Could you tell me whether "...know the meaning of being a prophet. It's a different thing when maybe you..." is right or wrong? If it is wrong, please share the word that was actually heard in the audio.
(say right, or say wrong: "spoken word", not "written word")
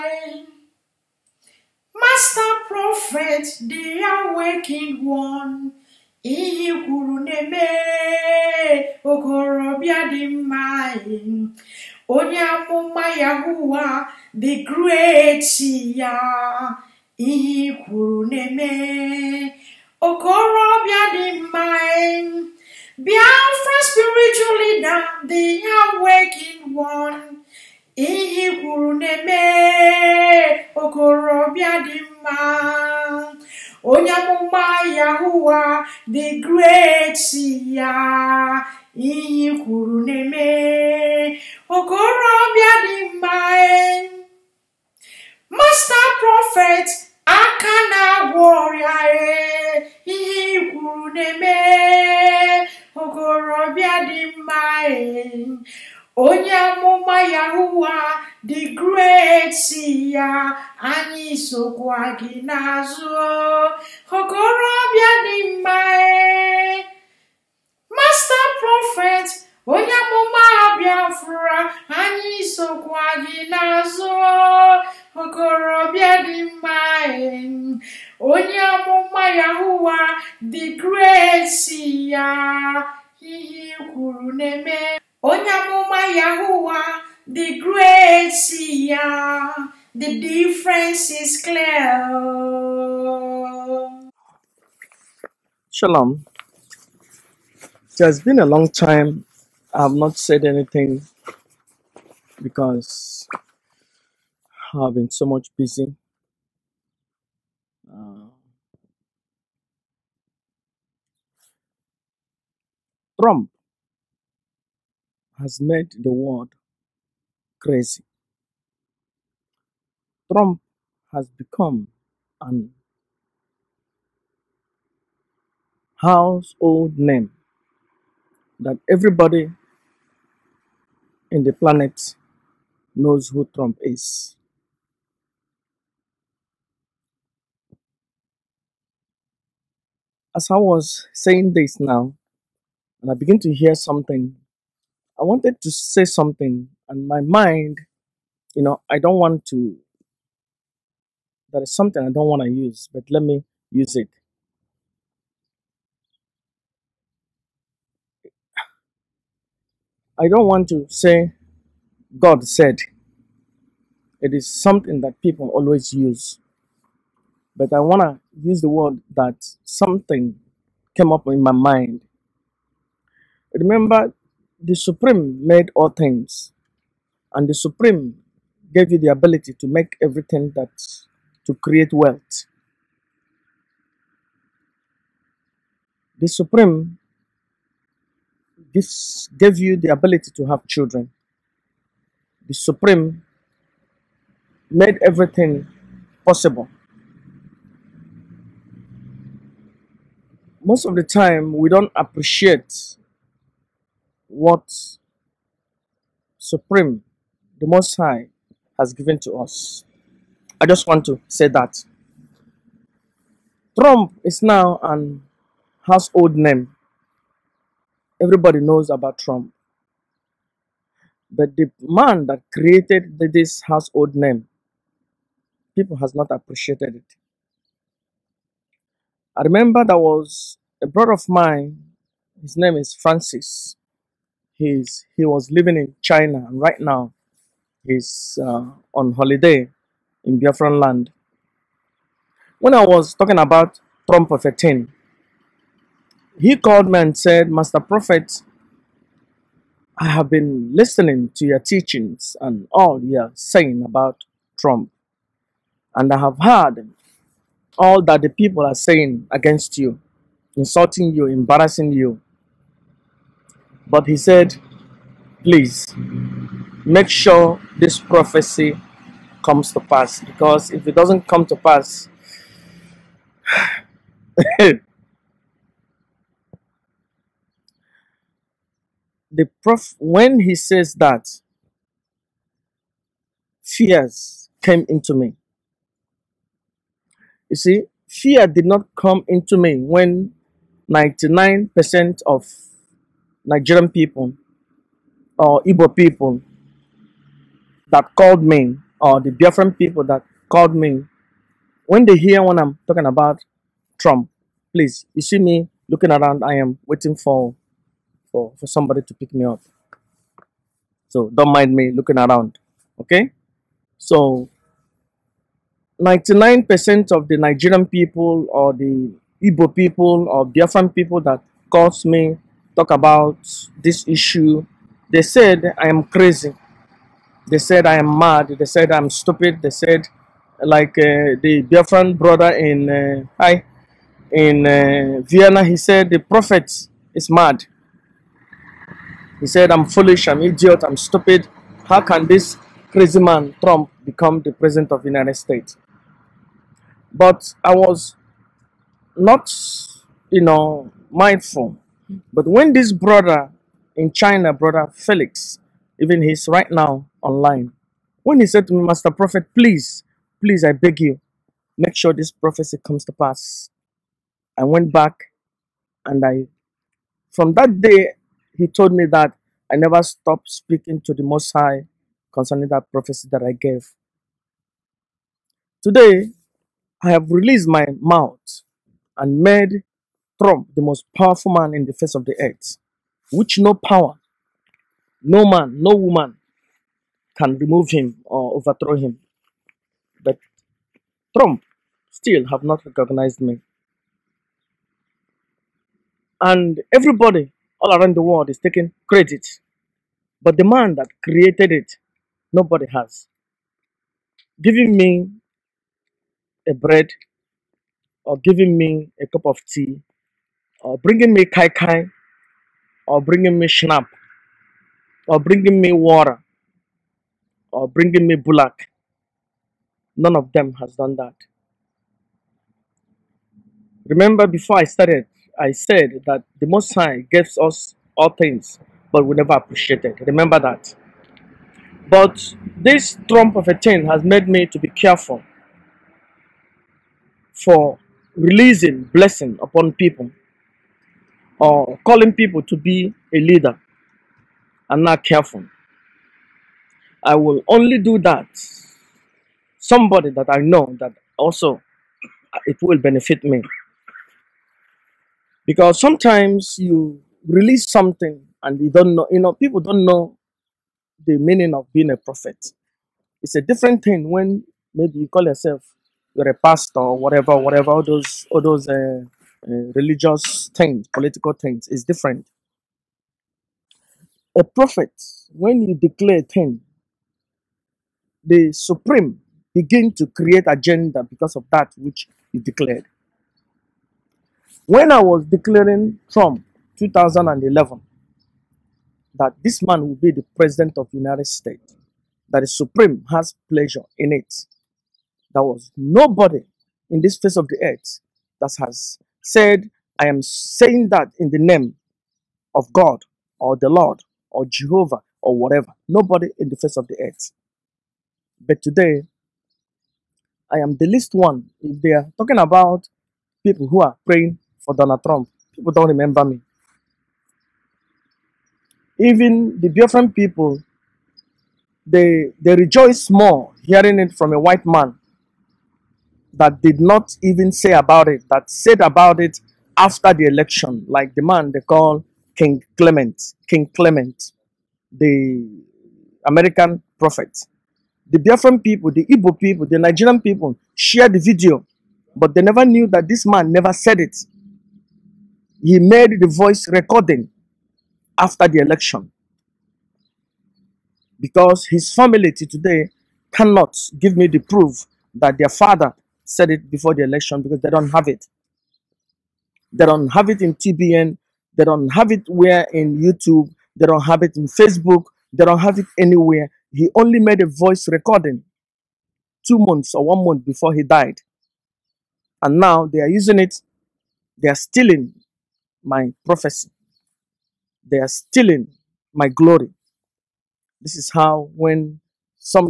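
right.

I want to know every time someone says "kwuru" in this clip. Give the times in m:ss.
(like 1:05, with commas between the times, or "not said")
0:06, 0:17, 0:28, 0:39, 0:50, 1:23.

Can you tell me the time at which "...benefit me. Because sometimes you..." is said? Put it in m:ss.
7:32.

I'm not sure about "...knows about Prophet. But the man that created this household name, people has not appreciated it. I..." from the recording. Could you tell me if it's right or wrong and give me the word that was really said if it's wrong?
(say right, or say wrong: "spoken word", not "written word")
wrong: "Trump", not "Prophet".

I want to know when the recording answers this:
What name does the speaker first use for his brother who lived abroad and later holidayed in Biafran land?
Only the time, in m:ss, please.
3:52.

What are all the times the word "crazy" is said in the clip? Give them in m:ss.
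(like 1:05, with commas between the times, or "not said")
1:57, 5:26, 5:42.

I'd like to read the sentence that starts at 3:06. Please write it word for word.
The Supreme gives, gave you the ability to have children.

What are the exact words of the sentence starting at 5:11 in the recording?
So don't mind me looking around, okay?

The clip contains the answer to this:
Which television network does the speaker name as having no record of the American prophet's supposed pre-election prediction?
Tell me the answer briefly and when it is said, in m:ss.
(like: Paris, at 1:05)
TBN, at 9:20.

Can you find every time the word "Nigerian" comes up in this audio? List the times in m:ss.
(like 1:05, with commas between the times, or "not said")
4:53, 5:17, 8:59.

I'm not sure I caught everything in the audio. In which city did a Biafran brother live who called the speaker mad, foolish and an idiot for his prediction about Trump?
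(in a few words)
Vienna.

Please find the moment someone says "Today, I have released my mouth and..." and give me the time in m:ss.
6:15.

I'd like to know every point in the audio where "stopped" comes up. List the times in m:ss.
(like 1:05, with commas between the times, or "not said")
6:10.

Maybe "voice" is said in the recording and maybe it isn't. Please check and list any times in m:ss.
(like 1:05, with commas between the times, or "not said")
9:06, 9:27.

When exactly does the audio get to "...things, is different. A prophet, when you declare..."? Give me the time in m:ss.
7:51.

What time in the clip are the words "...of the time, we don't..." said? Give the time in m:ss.
3:20.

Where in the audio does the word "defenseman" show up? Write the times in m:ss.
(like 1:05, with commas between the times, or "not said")
not said.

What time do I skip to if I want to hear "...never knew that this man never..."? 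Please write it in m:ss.
9:02.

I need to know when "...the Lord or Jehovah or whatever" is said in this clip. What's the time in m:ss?
8:23.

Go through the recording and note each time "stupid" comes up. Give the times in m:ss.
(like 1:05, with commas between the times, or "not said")
5:29, 5:40.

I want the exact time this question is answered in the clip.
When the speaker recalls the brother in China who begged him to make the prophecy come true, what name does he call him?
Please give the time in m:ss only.
5:54.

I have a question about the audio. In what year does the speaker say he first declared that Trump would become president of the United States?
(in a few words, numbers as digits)
2011.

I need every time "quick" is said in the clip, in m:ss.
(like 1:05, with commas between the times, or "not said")
not said.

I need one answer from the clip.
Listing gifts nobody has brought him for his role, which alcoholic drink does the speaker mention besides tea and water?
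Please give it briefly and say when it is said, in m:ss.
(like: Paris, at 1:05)
Schnapp, at 6:53.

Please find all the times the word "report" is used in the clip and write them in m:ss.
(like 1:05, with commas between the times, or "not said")
not said.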